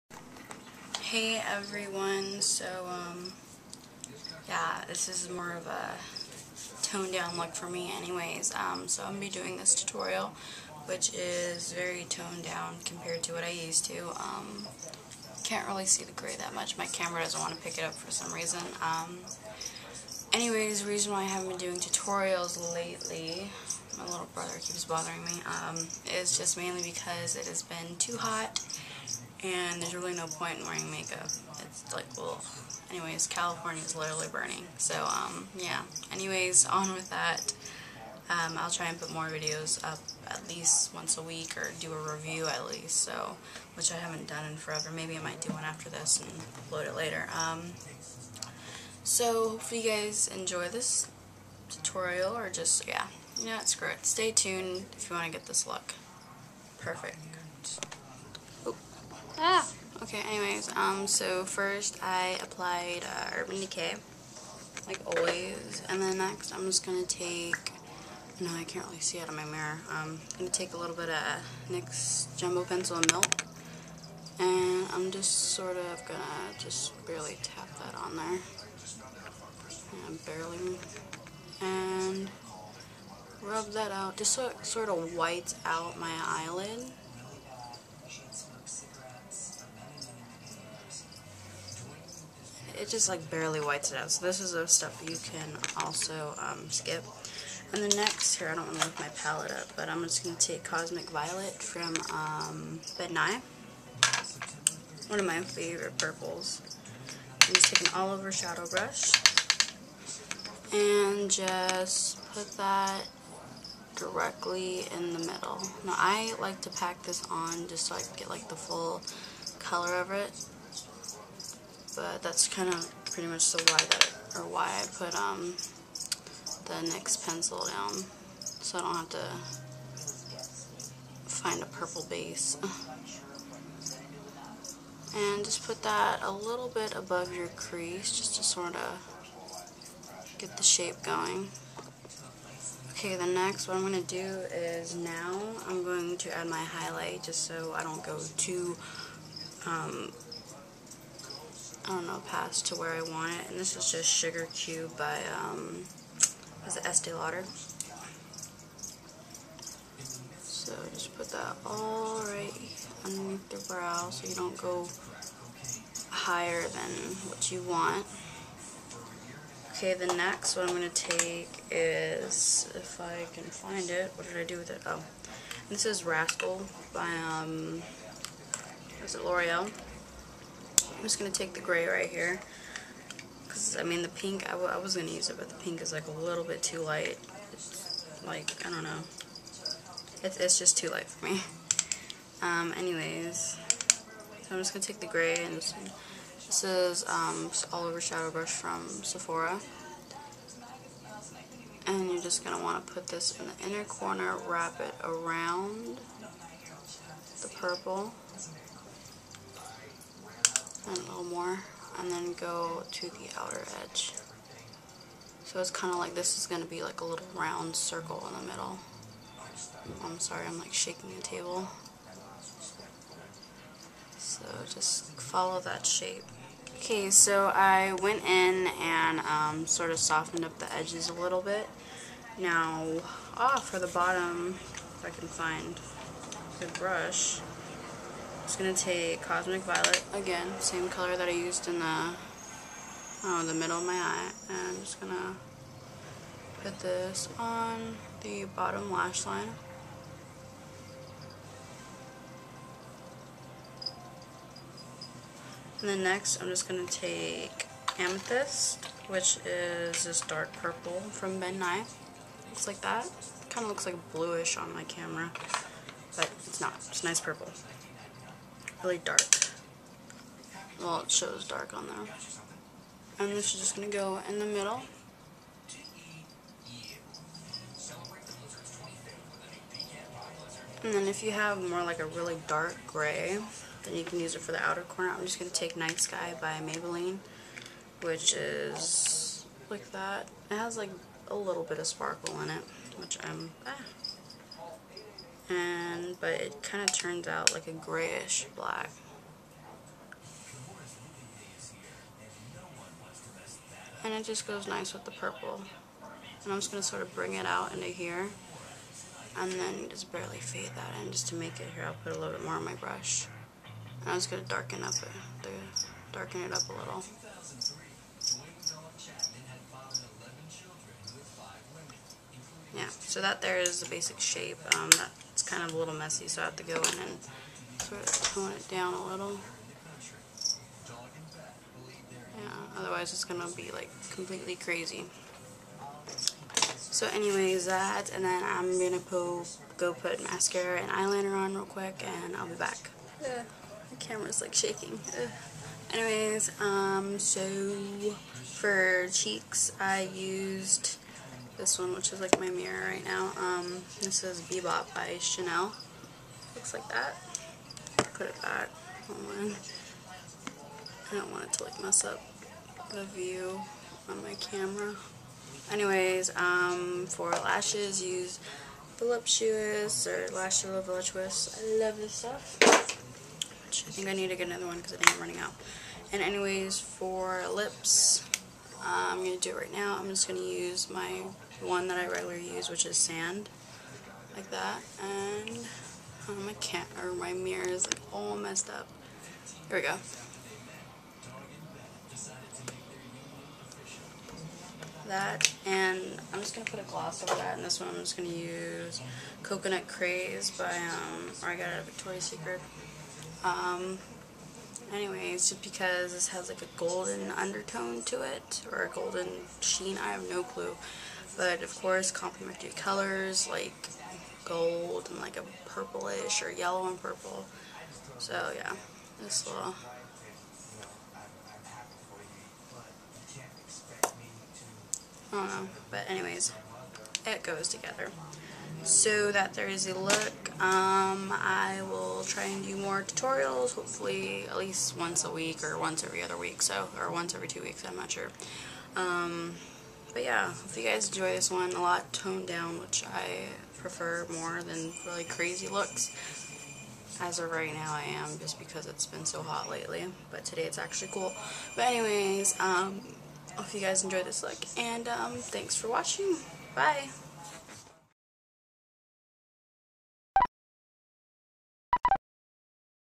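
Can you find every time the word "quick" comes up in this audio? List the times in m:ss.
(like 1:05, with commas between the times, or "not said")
5:41.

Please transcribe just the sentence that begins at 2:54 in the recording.
Oh, this is Rascal by, um, is it L'Oreal?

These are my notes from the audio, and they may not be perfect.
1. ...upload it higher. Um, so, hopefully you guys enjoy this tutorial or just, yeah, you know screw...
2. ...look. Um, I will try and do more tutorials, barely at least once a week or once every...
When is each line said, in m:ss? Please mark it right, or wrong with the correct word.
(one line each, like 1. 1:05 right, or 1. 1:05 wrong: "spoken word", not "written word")
1. 0:46 wrong: "later", not "higher"
2. 7:09 wrong: "hopefully", not "barely".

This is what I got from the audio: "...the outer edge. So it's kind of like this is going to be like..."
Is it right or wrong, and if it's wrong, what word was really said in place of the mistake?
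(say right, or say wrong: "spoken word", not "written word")
right.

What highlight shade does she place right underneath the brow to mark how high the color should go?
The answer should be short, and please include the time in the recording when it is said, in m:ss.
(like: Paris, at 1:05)
Sugar Cube, at 2:34.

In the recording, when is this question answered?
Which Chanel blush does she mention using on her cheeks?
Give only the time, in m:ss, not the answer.
5:54.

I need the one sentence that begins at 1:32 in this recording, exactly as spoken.
just like barely whites it out.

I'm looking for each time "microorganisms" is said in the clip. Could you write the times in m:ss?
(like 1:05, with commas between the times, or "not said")
not said.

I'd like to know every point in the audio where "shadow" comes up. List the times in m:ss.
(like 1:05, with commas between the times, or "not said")
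1:48, 3:18.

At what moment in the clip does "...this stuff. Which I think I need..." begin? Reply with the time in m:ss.
6:11.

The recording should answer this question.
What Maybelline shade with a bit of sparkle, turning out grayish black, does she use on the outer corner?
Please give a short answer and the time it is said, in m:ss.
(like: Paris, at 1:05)
Night Sky, at 4:45.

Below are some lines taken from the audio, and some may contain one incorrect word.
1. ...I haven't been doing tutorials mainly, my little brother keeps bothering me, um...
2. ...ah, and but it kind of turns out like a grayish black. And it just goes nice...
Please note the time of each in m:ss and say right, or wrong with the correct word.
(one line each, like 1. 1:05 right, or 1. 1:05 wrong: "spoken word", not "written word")
1. 0:21 wrong: "lately", not "mainly"
2. 4:53 right.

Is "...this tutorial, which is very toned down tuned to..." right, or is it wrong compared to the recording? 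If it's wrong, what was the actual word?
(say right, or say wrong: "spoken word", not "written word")
wrong: "compared", not "tuned".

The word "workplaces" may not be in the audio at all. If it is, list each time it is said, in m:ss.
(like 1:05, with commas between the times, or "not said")
not said.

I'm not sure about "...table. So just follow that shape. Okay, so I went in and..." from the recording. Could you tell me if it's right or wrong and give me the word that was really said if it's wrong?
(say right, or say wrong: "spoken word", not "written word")
right.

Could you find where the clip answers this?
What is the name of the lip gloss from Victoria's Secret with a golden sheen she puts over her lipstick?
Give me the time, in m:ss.
6:39.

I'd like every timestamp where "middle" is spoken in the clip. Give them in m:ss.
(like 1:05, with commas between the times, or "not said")
1:55, 3:38, 4:03, 4:34.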